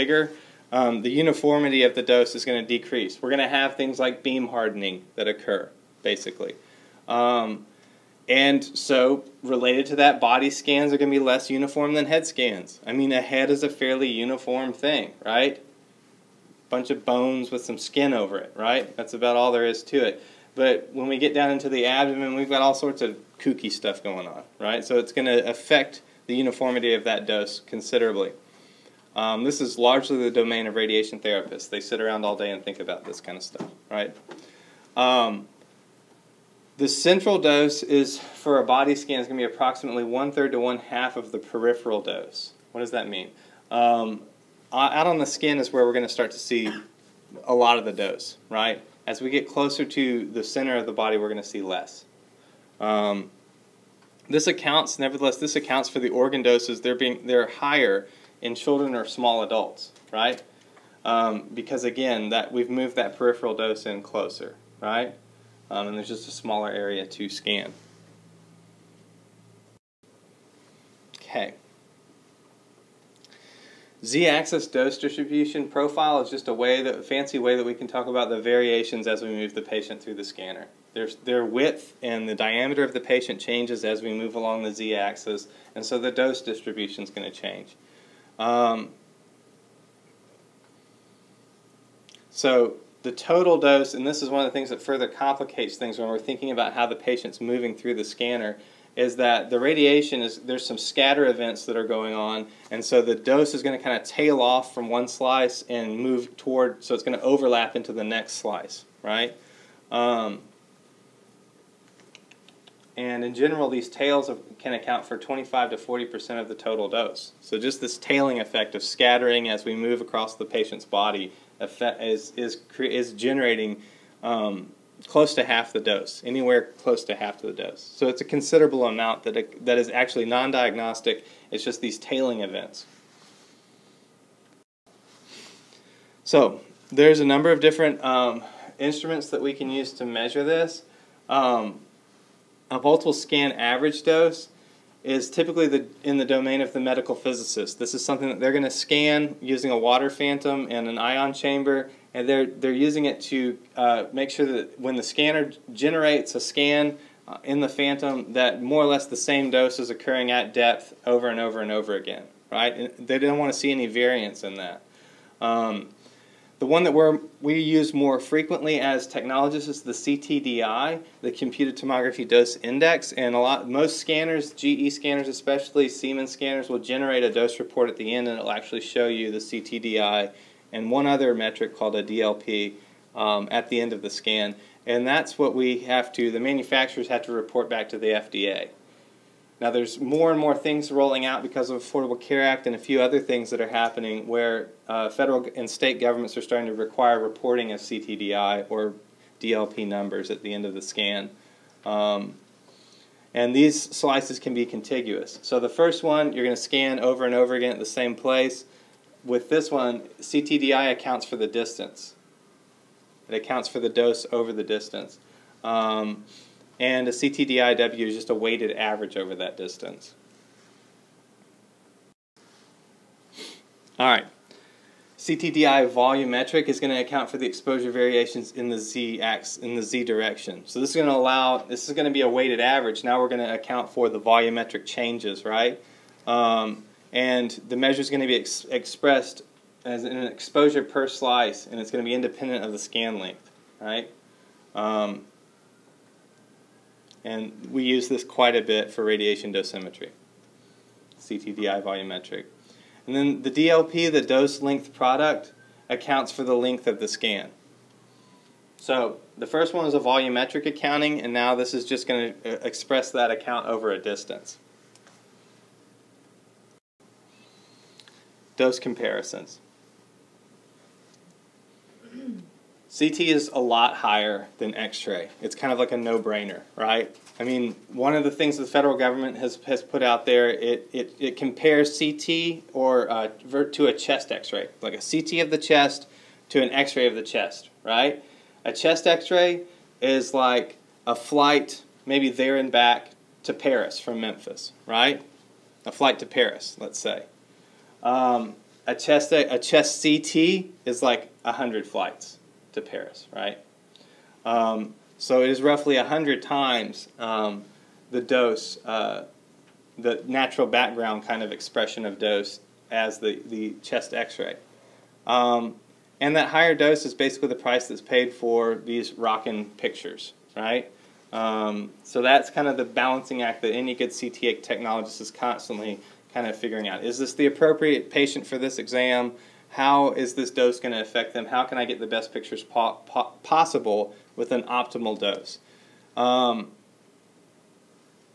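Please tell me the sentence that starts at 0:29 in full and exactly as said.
Um, this is largely the domain of radiation therapists.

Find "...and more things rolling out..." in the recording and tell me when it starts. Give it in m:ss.
3:10.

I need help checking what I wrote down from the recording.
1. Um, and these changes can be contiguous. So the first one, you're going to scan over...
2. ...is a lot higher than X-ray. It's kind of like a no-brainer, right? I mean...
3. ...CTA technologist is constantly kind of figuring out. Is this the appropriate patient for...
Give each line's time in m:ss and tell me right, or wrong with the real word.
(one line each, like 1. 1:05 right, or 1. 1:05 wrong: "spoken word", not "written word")
1. 3:21 wrong: "slices", not "changes"
2. 4:33 right
3. 5:24 right.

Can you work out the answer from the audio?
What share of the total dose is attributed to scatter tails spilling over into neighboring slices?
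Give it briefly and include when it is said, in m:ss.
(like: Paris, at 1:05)
25 to 40 percent, at 1:55.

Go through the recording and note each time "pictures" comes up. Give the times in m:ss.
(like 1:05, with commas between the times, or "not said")
5:19, 5:32.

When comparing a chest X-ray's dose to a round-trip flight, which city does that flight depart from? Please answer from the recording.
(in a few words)
Memphis.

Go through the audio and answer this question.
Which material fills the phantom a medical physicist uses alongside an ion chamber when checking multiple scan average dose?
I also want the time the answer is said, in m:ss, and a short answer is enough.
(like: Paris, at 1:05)
Water, at 2:29.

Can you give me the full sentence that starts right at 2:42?
And they don't want to see any variance in that.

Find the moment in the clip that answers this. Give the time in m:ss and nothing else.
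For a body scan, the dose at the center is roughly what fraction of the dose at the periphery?
0:40.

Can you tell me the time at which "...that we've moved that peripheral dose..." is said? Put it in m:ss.
1:02.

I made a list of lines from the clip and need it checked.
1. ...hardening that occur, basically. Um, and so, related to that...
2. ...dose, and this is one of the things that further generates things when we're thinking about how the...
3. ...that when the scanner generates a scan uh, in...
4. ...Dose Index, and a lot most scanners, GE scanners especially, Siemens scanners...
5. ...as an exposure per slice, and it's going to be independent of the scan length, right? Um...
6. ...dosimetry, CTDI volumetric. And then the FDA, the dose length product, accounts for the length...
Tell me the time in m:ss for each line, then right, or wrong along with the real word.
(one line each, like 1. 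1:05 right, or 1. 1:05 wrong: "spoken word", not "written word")
1. 0:04 right
2. 1:33 wrong: "complicates", not "generates"
3. 2:34 right
4. 2:52 right
5. 3:59 right
6. 4:09 wrong: "DLP", not "FDA".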